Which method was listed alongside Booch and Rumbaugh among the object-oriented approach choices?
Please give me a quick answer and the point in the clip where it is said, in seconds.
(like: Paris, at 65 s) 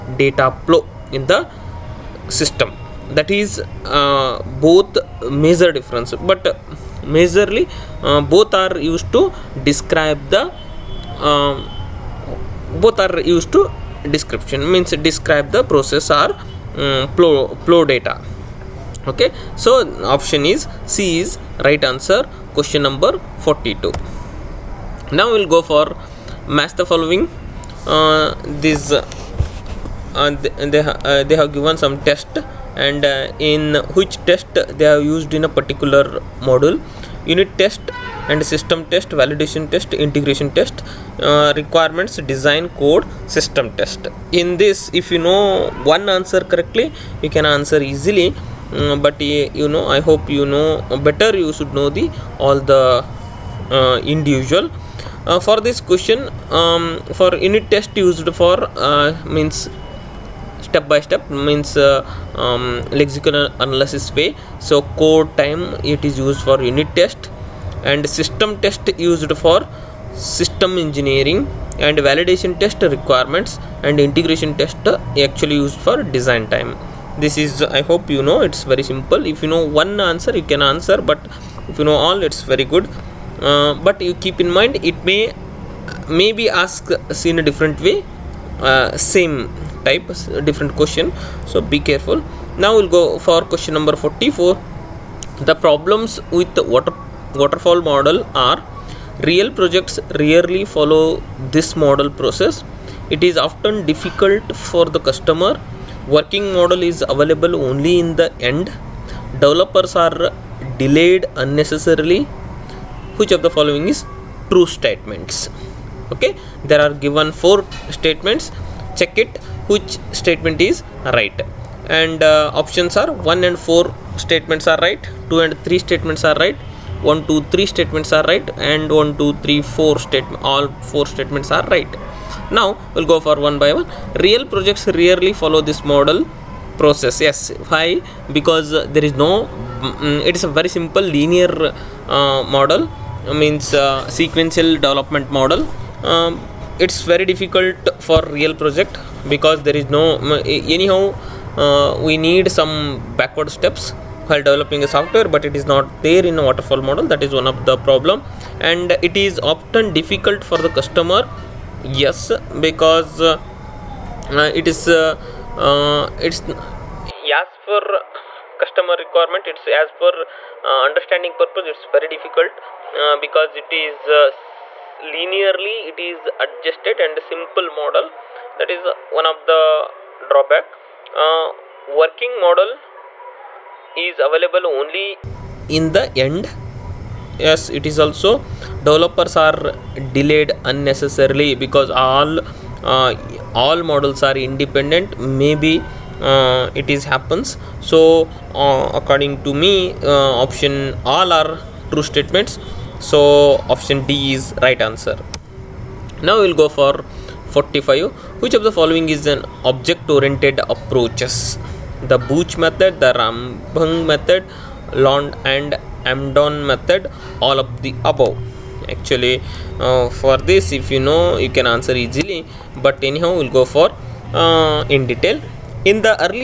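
Lond and Amdon method, at 214 s.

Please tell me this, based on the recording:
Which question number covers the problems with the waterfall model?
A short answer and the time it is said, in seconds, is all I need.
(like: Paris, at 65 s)
44, at 93 s.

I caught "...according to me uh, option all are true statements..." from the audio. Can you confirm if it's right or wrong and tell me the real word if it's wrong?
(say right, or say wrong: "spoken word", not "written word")
right.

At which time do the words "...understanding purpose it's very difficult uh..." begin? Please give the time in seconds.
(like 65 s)
170 s.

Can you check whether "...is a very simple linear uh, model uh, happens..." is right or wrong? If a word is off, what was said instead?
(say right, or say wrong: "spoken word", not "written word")
wrong: "means", not "happens".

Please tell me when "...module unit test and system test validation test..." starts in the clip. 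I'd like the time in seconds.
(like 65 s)
36 s.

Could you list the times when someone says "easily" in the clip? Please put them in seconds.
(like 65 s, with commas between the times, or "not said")
47 s, 221 s.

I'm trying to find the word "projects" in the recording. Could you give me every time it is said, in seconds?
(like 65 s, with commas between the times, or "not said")
99 s, 134 s, 148 s.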